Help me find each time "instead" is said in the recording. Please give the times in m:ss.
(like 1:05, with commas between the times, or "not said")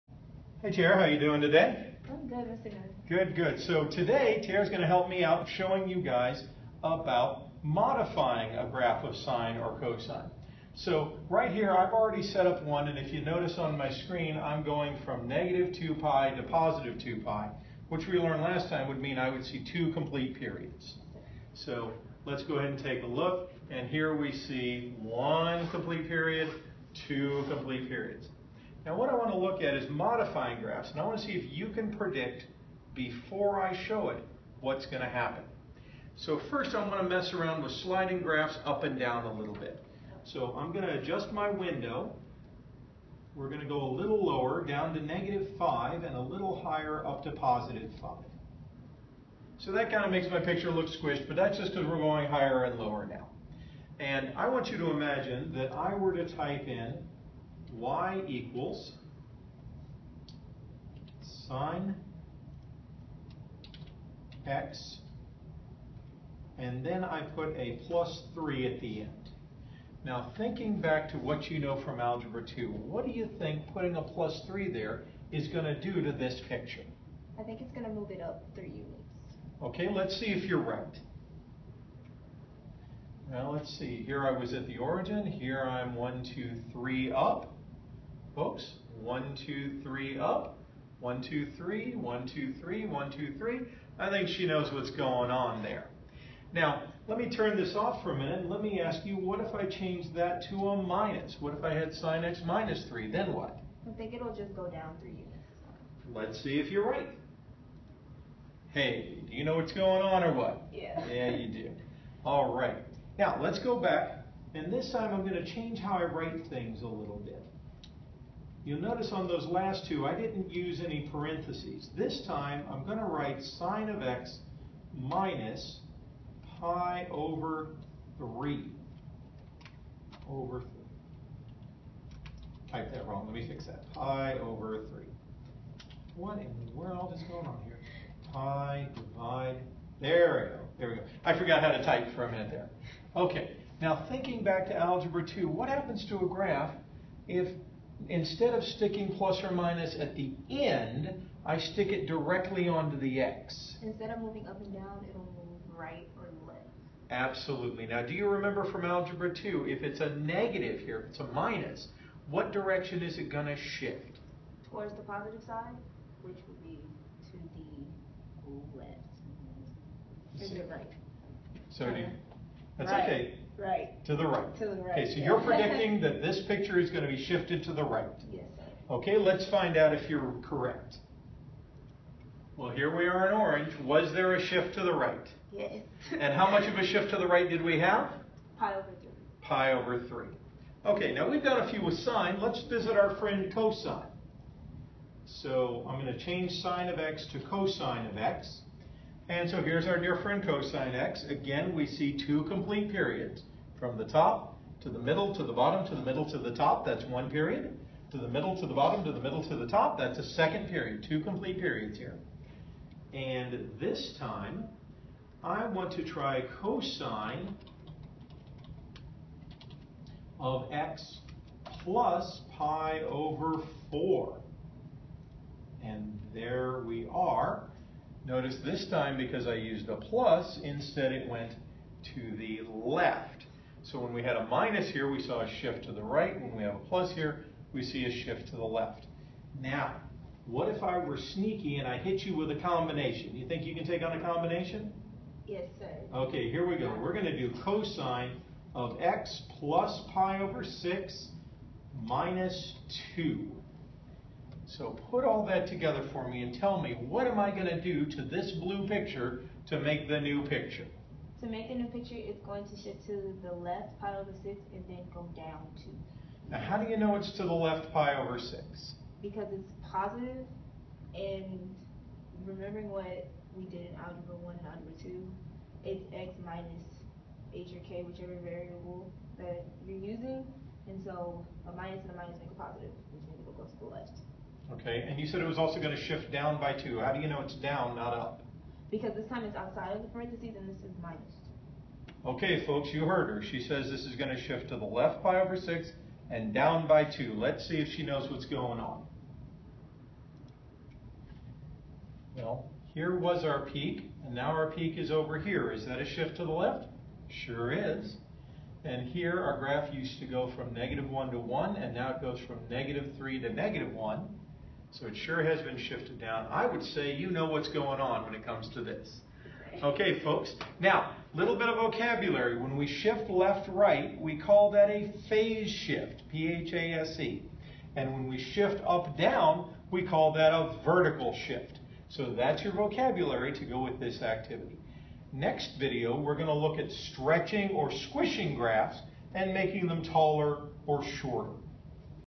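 2:28, 2:33, 3:50.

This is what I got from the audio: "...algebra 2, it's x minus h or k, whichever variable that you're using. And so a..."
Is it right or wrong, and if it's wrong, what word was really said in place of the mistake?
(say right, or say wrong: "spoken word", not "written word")
right.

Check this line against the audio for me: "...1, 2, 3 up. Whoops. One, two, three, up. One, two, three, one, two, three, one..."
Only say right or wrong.
right.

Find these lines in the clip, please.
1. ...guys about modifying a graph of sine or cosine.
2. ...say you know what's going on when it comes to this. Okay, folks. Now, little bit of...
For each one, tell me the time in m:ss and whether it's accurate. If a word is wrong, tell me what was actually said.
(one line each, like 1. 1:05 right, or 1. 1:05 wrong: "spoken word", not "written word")
1. 0:06 right
2. 5:16 right.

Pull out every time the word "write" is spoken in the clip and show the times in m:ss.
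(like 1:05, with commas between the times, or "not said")
1:56, 2:03.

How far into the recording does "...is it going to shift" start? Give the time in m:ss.
2:43.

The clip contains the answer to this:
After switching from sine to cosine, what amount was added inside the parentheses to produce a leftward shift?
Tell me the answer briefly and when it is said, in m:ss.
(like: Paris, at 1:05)
pi/4, at 3:42.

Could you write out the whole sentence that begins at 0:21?
So let's go ahead and take a look, and here we see one complete period, two complete periods.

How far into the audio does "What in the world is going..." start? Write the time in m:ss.
2:16.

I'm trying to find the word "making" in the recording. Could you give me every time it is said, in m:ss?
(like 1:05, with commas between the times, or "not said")
4:21, 5:39.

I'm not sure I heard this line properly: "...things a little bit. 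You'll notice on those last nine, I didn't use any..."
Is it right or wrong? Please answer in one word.
wrong.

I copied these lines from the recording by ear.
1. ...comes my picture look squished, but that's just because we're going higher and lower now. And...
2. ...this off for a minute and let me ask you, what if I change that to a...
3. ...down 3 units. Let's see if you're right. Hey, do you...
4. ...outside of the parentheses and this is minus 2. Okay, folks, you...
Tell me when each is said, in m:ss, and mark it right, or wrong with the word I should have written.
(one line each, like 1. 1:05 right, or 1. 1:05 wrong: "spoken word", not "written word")
1. 0:50 wrong: "makes", not "comes"
2. 1:37 right
3. 1:44 right
4. 4:49 right.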